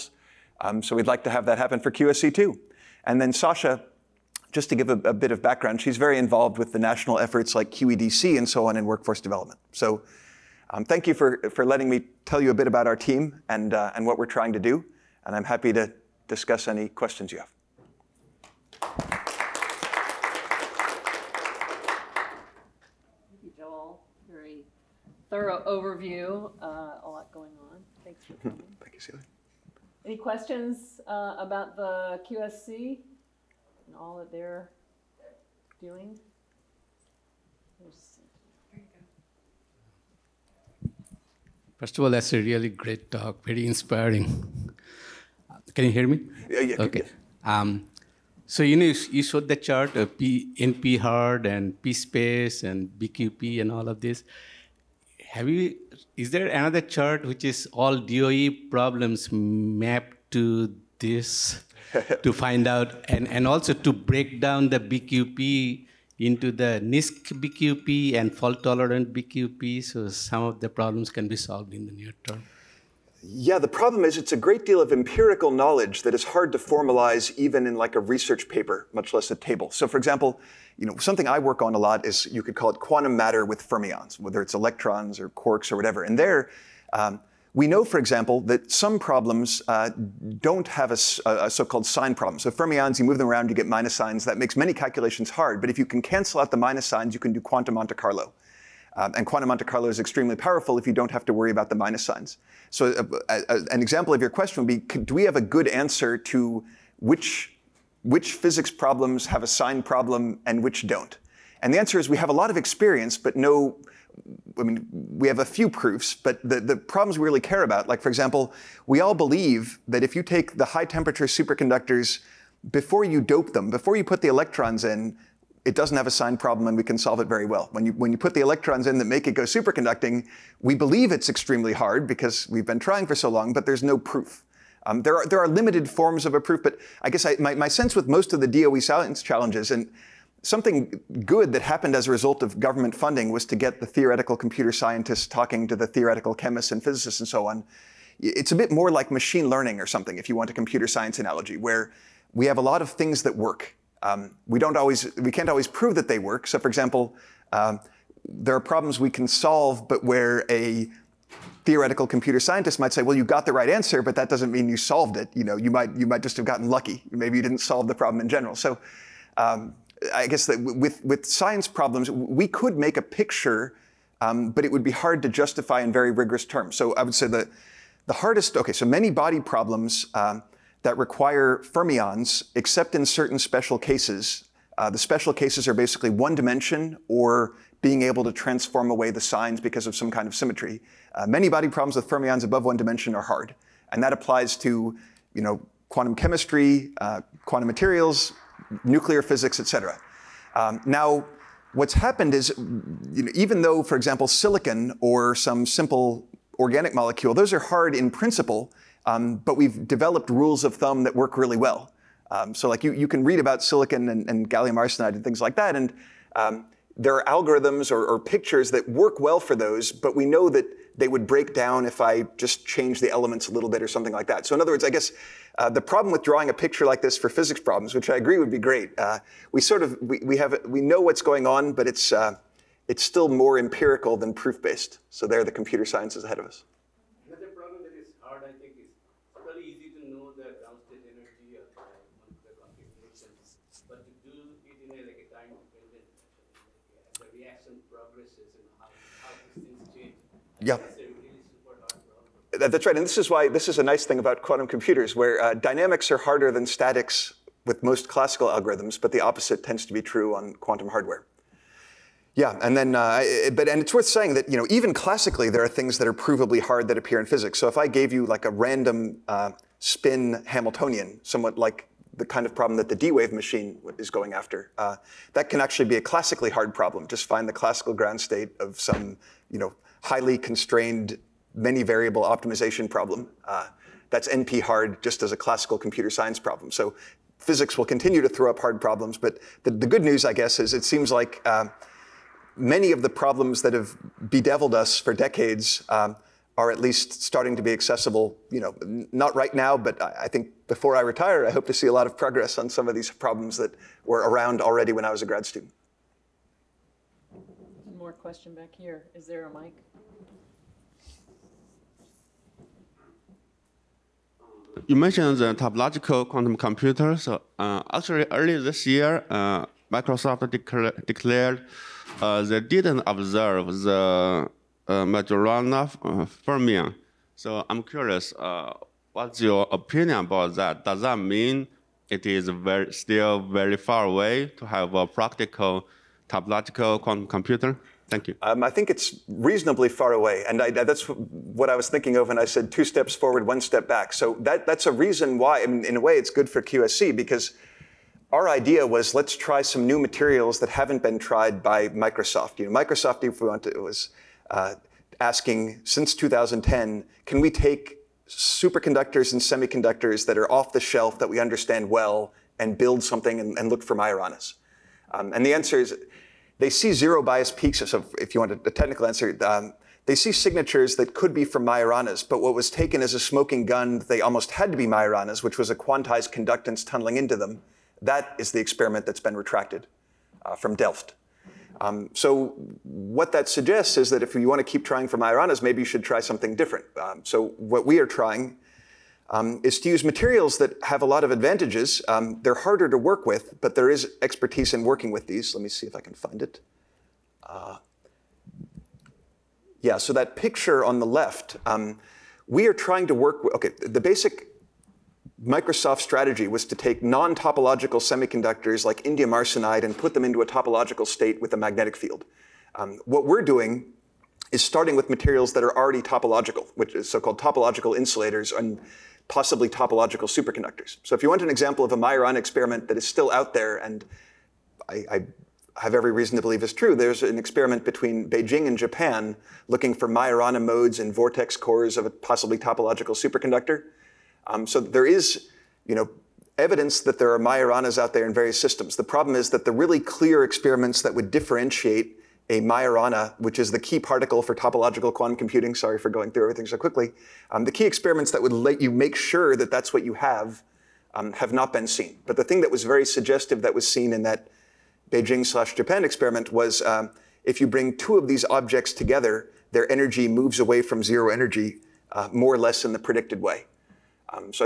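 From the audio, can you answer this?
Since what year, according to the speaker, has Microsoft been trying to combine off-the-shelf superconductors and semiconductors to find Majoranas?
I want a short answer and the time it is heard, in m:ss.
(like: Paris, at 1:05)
2010, at 5:56.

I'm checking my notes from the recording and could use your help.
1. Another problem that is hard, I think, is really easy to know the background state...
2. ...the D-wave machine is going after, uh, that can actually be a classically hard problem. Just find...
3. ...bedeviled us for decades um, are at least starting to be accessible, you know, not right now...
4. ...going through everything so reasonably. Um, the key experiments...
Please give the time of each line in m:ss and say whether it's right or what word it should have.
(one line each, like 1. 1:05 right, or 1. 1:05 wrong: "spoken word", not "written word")
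1. 3:57 wrong: "ground", not "background"
2. 4:32 right
3. 4:54 right
4. 7:26 wrong: "quickly", not "reasonably".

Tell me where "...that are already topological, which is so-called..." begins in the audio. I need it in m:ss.
6:55.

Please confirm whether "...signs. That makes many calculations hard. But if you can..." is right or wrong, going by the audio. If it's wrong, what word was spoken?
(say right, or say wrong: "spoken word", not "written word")
right.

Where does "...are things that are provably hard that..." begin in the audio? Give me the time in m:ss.
4:25.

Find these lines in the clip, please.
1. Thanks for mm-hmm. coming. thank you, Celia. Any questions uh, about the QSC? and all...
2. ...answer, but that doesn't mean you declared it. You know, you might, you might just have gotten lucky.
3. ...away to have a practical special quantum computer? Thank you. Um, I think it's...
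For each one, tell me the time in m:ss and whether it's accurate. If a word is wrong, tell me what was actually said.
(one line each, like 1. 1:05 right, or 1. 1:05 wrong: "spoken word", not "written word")
1. 0:28 right
2. 2:43 wrong: "solved", not "declared"
3. 5:34 wrong: "topological", not "special".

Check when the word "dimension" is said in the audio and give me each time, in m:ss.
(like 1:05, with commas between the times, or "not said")
3:06, 3:12.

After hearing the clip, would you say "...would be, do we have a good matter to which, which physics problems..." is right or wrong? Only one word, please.
wrong.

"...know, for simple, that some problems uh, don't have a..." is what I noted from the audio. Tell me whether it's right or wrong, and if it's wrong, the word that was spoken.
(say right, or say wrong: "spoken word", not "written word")
wrong: "example", not "simple".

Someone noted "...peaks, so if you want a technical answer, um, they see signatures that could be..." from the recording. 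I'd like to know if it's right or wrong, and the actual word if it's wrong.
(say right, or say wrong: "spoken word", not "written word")
right.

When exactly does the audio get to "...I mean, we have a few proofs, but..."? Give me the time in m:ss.
1:54.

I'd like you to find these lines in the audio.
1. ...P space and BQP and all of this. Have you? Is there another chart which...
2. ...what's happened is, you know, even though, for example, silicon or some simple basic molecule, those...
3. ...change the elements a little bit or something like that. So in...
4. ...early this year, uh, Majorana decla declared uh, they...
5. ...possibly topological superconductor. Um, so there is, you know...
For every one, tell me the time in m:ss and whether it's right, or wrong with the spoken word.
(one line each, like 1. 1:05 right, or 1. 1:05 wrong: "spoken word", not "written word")
1. 0:51 right
2. 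3:21 wrong: "organic", not "basic"
3. 3:42 right
4. 5:18 wrong: "Microsoft", not "Majorana"
5. 7:12 right.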